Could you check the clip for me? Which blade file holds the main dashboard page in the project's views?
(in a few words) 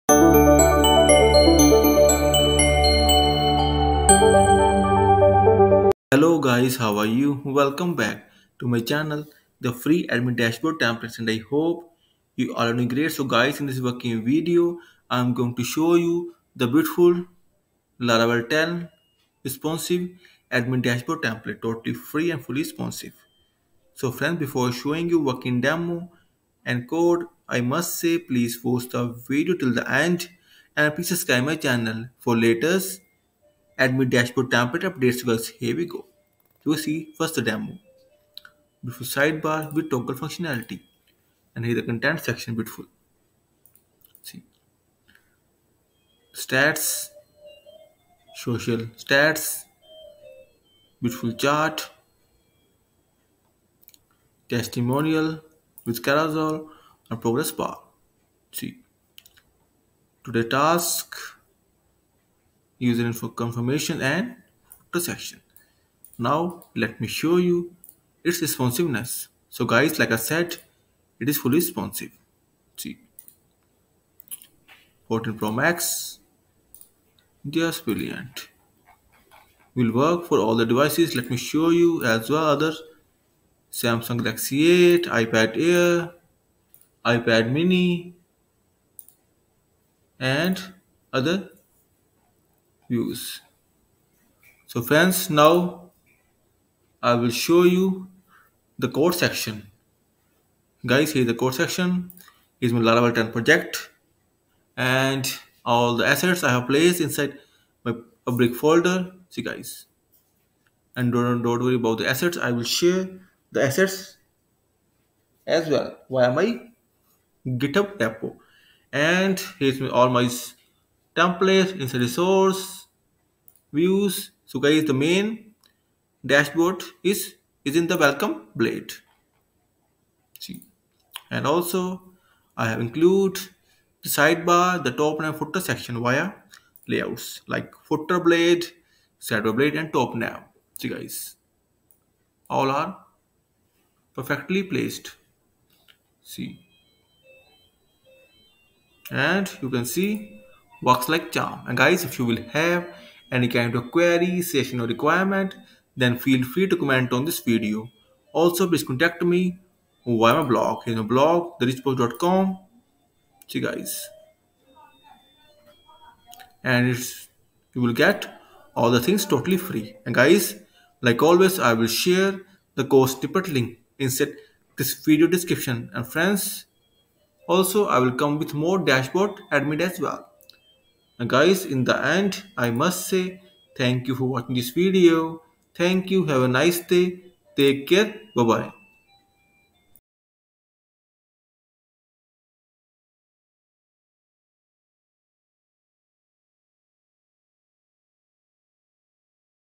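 welcome blade.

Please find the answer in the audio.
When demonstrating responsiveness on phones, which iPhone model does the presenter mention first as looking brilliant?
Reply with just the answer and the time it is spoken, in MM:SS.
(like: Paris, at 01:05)
14 Pro Max, at 01:15.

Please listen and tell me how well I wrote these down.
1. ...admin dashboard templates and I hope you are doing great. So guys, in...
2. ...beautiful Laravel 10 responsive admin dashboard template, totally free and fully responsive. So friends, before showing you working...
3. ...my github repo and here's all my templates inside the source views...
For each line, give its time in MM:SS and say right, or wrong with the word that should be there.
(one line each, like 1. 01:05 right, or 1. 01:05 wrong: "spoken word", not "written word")
1. 00:10 right
2. 00:16 right
3. 01:56 right.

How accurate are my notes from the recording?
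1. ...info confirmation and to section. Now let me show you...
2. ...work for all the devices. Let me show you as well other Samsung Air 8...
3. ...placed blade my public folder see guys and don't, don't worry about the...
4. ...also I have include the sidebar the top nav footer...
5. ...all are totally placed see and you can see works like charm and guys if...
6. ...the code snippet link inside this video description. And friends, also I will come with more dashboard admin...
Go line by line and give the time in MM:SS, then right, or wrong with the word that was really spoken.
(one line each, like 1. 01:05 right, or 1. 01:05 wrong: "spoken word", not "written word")
1. 01:03 right
2. 01:19 wrong: "Galaxy", not "Air"
3. 01:46 wrong: "inside", not "blade"
4. 02:11 right
5. 02:22 wrong: "perfectly", not "totally"
6. 02:52 right.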